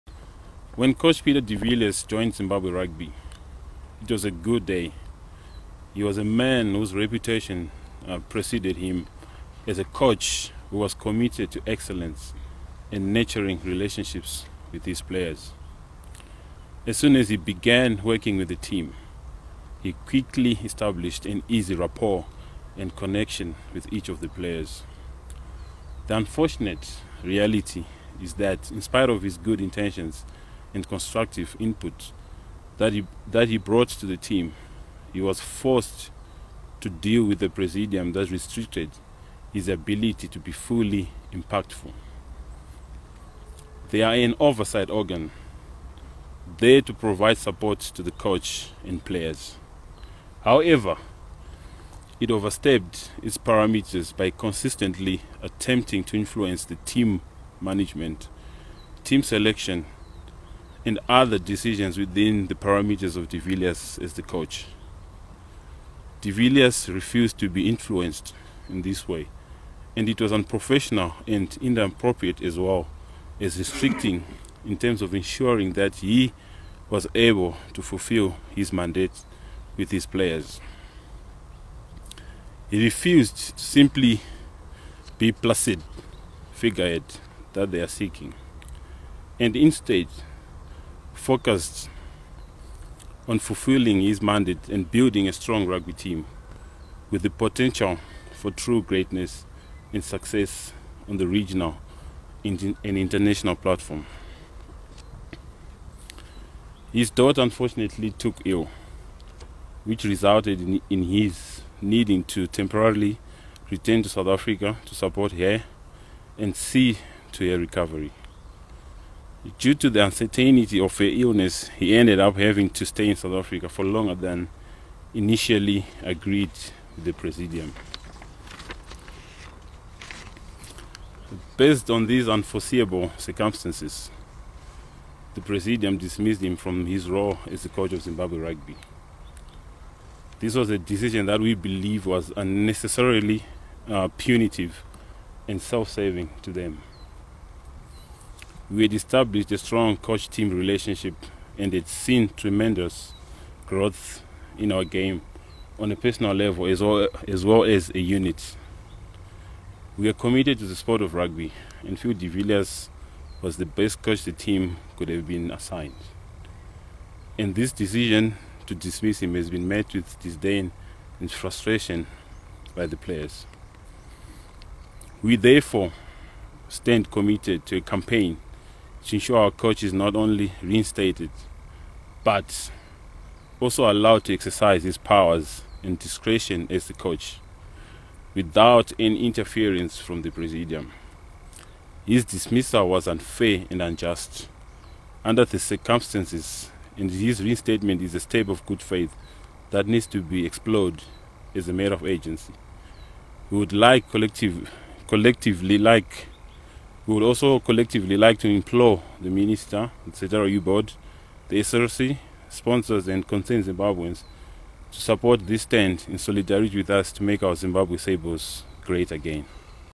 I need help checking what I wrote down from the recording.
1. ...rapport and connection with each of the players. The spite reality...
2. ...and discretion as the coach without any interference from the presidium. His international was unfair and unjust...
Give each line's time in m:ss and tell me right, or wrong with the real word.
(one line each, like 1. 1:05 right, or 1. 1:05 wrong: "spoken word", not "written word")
1. 0:21 wrong: "unfortunate", not "spite"
2. 3:05 wrong: "dismissal", not "international".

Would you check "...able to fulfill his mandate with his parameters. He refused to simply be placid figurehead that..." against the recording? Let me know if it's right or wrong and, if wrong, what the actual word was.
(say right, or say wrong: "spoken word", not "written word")
wrong: "players", not "parameters".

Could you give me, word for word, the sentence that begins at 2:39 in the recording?
We are committed to the sport of rugby and Phil de Villiers was the best coach the team could have been assigned.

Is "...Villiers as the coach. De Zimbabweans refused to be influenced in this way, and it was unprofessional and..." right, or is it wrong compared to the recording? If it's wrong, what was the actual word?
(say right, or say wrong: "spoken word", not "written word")
wrong: "Villiers", not "Zimbabweans".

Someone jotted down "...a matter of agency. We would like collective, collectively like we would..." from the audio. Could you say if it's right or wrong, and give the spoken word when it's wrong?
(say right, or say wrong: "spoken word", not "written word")
right.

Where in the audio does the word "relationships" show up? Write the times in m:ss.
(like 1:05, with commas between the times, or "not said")
0:13, 2:30.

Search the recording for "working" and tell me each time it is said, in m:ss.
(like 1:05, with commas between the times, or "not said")
0:18.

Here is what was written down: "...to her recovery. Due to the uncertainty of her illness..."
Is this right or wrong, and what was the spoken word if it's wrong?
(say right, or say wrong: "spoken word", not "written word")
right.